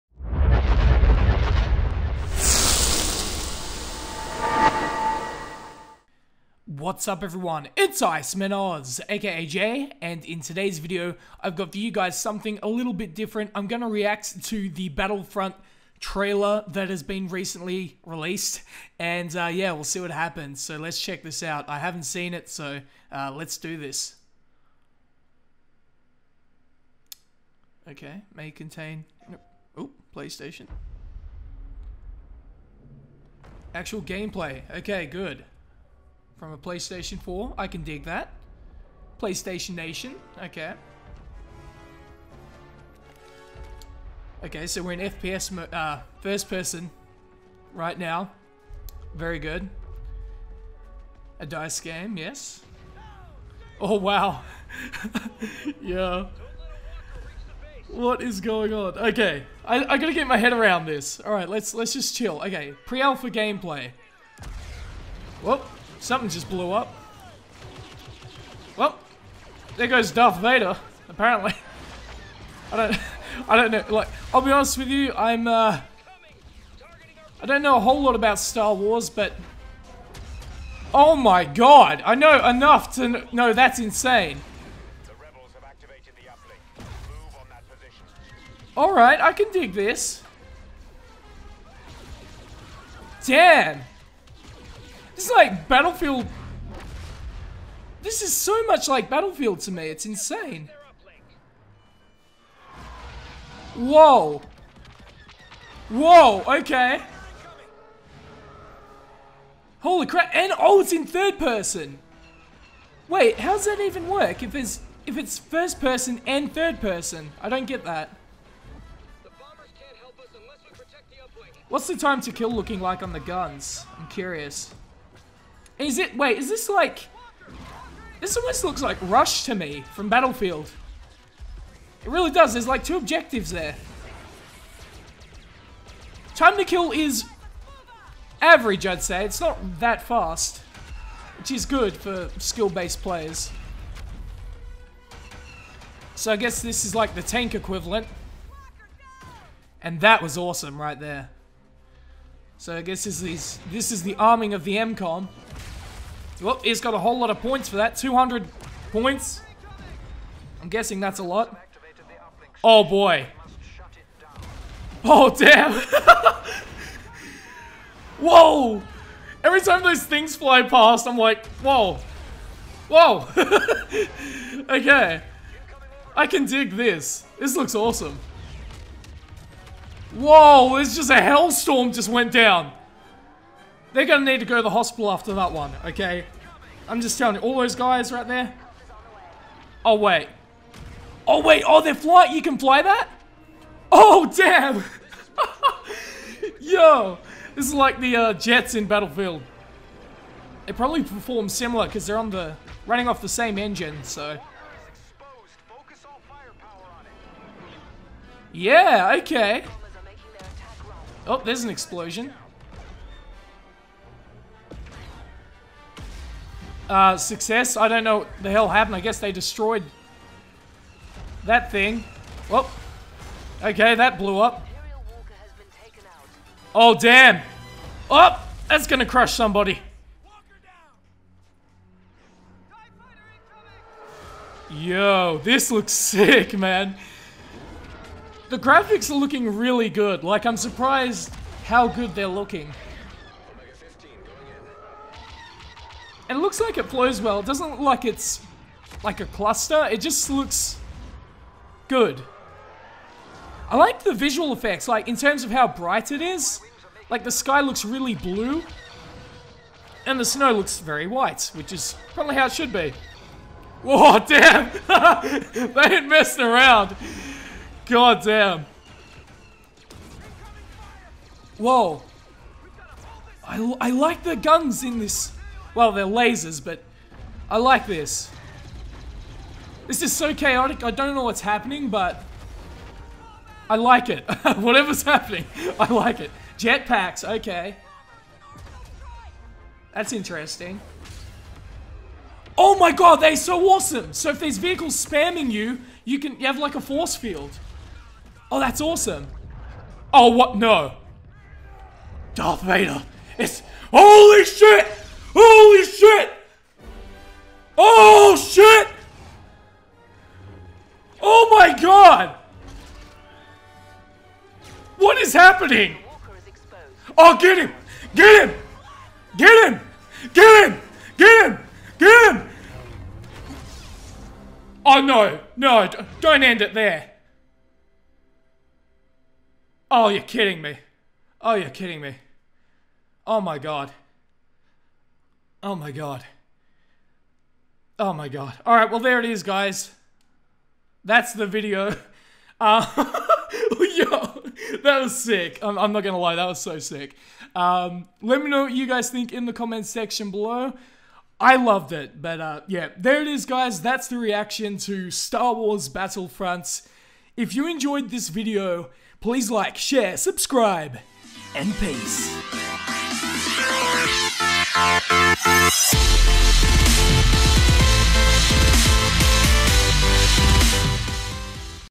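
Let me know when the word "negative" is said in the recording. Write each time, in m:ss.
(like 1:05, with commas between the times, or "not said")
not said.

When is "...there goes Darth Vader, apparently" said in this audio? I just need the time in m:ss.
1:09.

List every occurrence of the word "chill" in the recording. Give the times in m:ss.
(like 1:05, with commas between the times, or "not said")
1:02.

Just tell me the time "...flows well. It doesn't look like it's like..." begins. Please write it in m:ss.
4:06.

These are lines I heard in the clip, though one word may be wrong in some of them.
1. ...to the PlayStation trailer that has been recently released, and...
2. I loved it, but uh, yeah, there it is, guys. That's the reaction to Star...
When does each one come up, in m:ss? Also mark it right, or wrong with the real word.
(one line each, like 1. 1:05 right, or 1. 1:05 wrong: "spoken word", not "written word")
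1. 0:14 wrong: "Battlefront", not "PlayStation"
2. 5:51 right.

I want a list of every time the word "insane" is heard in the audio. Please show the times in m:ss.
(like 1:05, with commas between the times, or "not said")
1:23, 1:40.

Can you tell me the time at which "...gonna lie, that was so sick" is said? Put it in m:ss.
5:46.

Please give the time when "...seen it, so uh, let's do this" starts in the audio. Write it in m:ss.
0:22.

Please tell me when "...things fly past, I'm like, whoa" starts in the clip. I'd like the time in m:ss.
2:50.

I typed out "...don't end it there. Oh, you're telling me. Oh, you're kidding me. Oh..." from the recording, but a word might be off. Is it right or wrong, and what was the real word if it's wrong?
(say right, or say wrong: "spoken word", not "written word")
wrong: "kidding", not "telling".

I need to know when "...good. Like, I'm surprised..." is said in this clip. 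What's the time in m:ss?
3:59.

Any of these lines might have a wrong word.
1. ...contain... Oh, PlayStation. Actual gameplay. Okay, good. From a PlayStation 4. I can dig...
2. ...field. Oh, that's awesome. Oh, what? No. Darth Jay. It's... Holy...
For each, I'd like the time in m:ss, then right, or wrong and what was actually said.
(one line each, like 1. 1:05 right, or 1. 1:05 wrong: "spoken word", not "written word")
1. 0:28 right
2. 4:57 wrong: "Vader", not "Jay".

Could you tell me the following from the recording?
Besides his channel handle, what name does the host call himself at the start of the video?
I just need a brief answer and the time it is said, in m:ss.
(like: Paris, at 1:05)
Jay, at 0:09.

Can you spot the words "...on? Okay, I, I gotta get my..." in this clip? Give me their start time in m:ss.
0:58.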